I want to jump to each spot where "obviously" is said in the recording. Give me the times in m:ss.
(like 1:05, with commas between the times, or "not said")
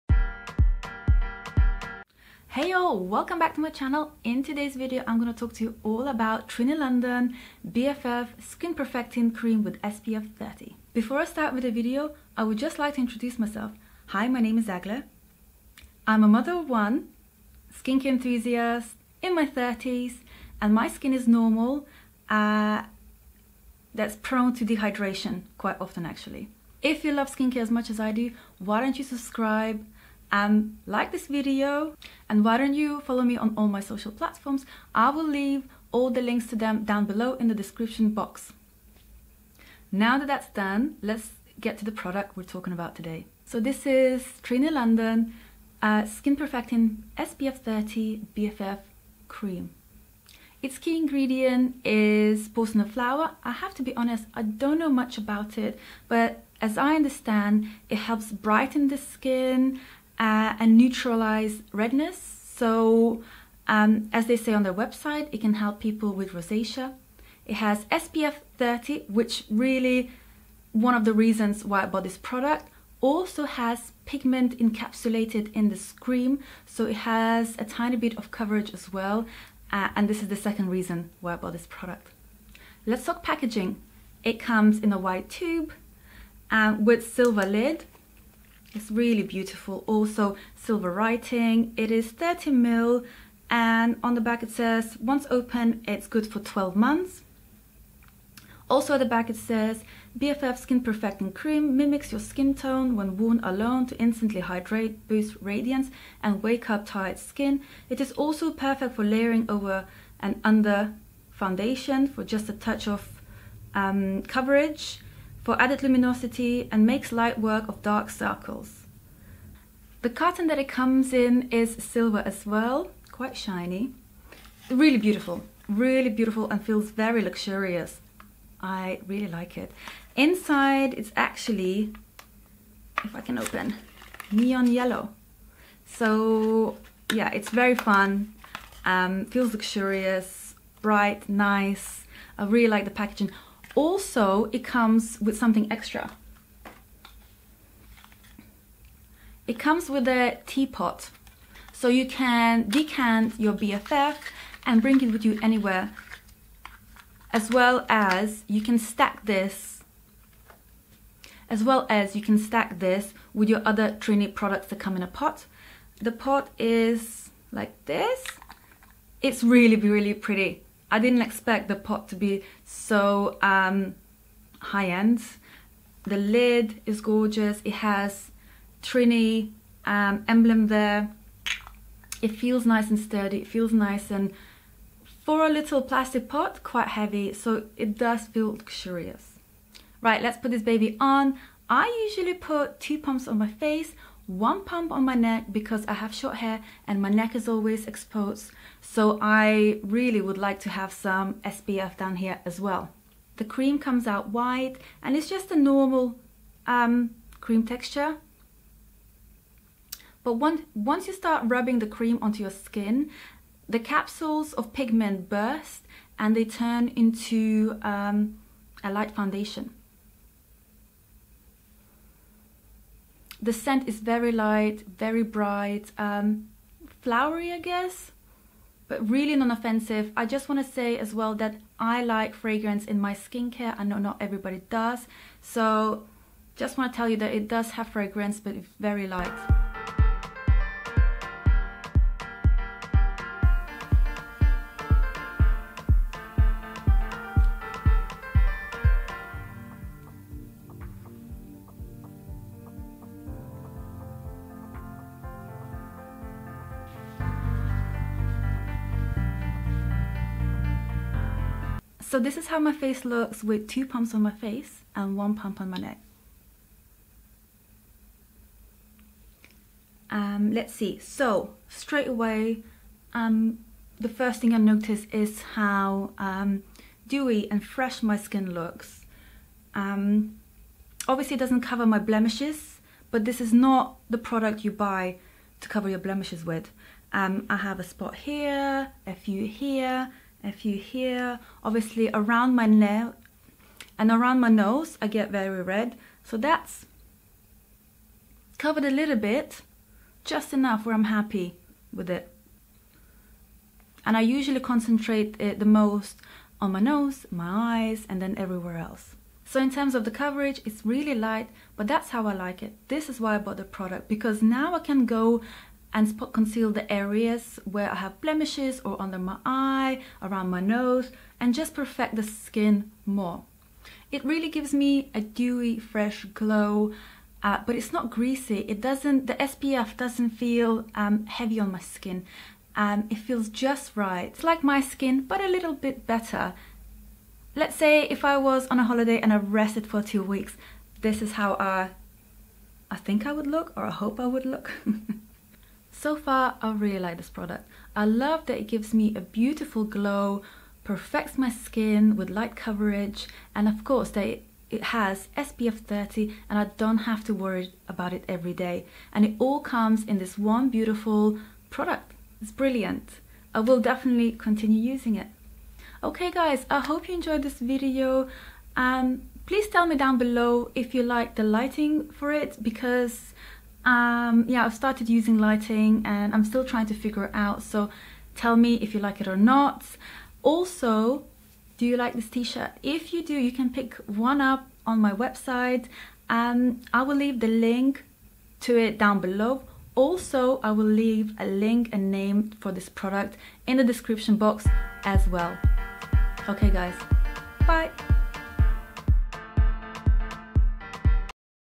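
4:41, 4:51.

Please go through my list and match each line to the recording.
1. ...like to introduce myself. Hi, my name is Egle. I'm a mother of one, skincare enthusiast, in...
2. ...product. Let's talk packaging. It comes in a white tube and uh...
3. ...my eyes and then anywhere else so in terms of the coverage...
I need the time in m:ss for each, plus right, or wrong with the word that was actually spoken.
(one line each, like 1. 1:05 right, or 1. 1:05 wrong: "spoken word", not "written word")
1. 0:12 right
2. 1:21 right
3. 5:07 wrong: "everywhere", not "anywhere".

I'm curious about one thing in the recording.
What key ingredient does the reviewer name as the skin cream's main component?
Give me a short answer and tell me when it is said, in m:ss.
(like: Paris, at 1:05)
porcelain flower, at 0:52.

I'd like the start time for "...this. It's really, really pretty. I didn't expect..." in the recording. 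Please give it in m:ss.
2:47.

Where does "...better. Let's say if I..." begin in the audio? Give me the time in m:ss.
5:36.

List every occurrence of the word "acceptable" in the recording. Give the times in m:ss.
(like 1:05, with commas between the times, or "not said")
not said.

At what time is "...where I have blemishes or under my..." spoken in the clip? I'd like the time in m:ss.
5:17.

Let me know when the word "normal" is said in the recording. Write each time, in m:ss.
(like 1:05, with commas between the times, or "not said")
0:21, 3:25.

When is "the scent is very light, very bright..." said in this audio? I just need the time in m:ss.
3:43.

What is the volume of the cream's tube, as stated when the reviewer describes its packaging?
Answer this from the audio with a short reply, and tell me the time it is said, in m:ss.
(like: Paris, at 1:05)
30 ml, at 1:32.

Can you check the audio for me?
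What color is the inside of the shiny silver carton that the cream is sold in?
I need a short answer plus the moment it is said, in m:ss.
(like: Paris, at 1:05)
neon yellow, at 2:14.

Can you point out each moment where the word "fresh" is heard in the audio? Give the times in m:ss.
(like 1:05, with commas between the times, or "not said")
4:37, 5:25.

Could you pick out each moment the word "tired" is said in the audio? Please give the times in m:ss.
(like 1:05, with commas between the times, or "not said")
1:46.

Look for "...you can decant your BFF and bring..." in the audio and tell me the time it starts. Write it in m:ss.
2:31.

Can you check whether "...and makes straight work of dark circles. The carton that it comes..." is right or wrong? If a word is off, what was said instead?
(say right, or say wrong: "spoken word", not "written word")
wrong: "light", not "straight".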